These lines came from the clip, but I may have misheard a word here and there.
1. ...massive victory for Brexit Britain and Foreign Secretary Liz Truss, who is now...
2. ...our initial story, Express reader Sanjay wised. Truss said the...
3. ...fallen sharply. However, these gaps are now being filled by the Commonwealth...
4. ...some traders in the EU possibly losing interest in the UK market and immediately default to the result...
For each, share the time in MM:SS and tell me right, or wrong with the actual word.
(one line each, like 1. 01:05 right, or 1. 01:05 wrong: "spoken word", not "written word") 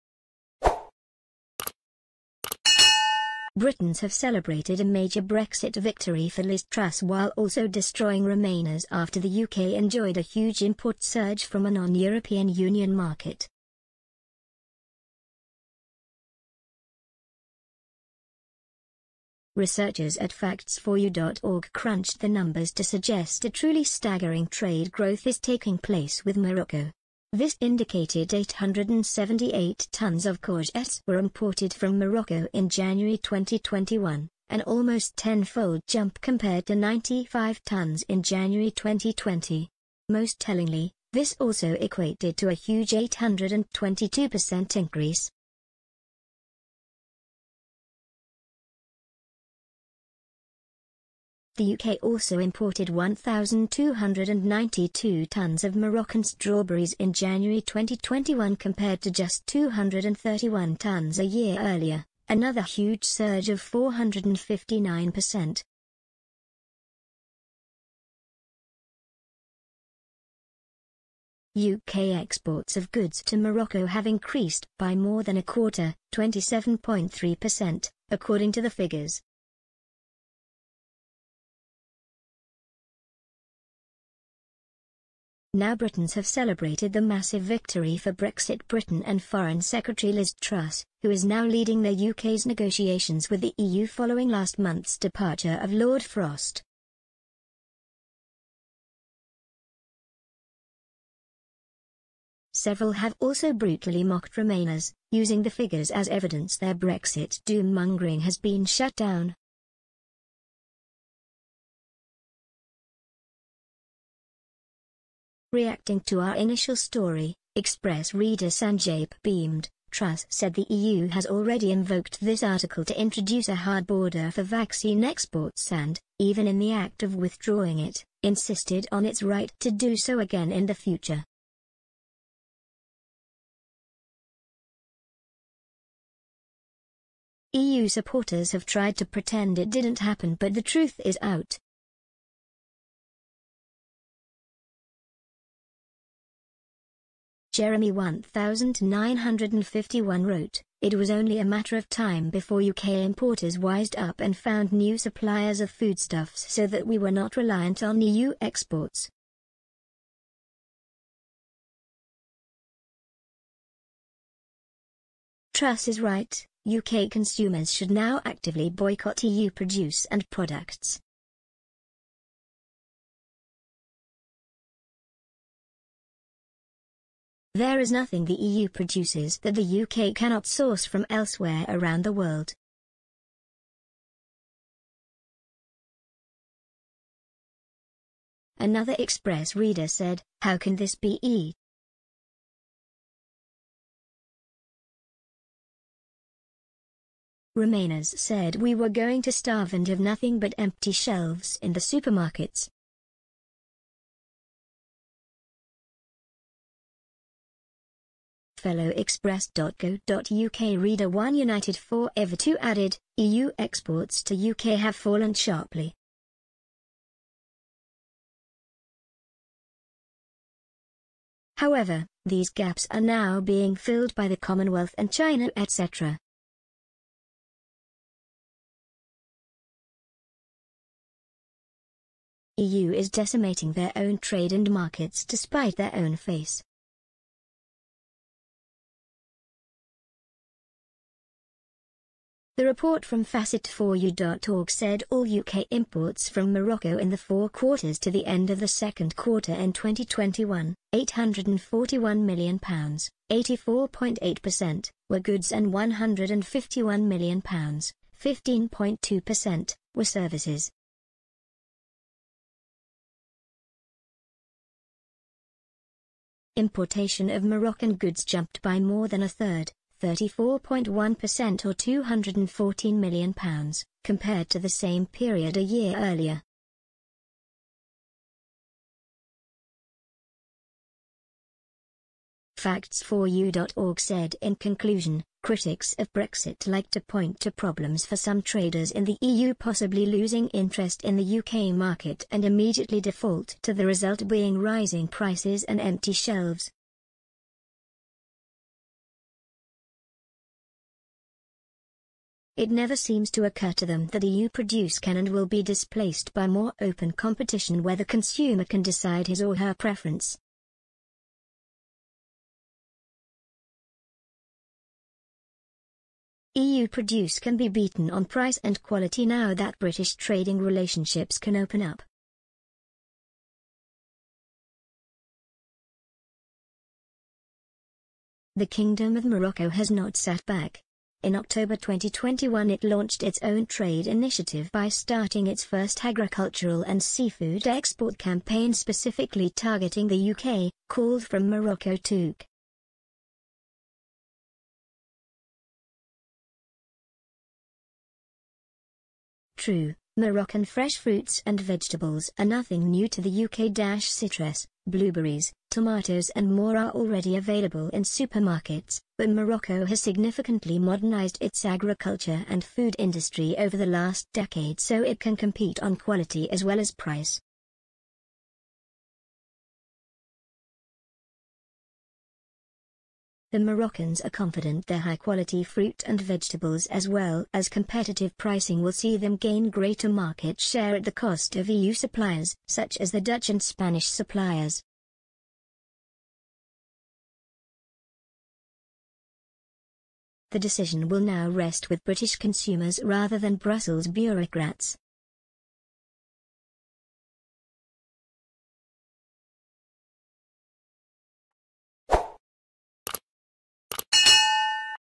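1. 01:27 right
2. 01:56 wrong: "beamed", not "wised"
3. 03:34 right
4. 04:48 right.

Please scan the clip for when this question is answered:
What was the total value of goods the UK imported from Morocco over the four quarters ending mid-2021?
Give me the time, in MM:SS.
04:10.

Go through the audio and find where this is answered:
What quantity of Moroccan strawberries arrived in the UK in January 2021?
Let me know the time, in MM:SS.
00:52.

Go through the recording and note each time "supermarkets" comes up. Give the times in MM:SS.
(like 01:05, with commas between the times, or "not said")
03:21, 05:58.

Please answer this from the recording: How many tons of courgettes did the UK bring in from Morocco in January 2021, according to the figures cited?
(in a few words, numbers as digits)
878 tons.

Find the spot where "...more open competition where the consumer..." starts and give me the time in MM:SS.
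05:06.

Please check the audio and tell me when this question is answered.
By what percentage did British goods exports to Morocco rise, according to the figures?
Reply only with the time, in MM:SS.
01:16.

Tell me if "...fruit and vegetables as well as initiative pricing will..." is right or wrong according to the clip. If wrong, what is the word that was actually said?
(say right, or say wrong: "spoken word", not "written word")
wrong: "competitive", not "initiative".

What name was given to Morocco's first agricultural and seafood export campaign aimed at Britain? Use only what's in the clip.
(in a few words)
From Morocco to UK.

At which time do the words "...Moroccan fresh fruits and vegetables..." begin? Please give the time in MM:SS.
05:50.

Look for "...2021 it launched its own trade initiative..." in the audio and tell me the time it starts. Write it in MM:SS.
05:31.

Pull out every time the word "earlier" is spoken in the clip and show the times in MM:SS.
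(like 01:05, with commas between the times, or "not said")
01:01, 04:35.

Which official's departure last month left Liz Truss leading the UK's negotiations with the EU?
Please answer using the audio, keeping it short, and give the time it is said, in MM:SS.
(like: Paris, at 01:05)
Lord Frost, at 01:35.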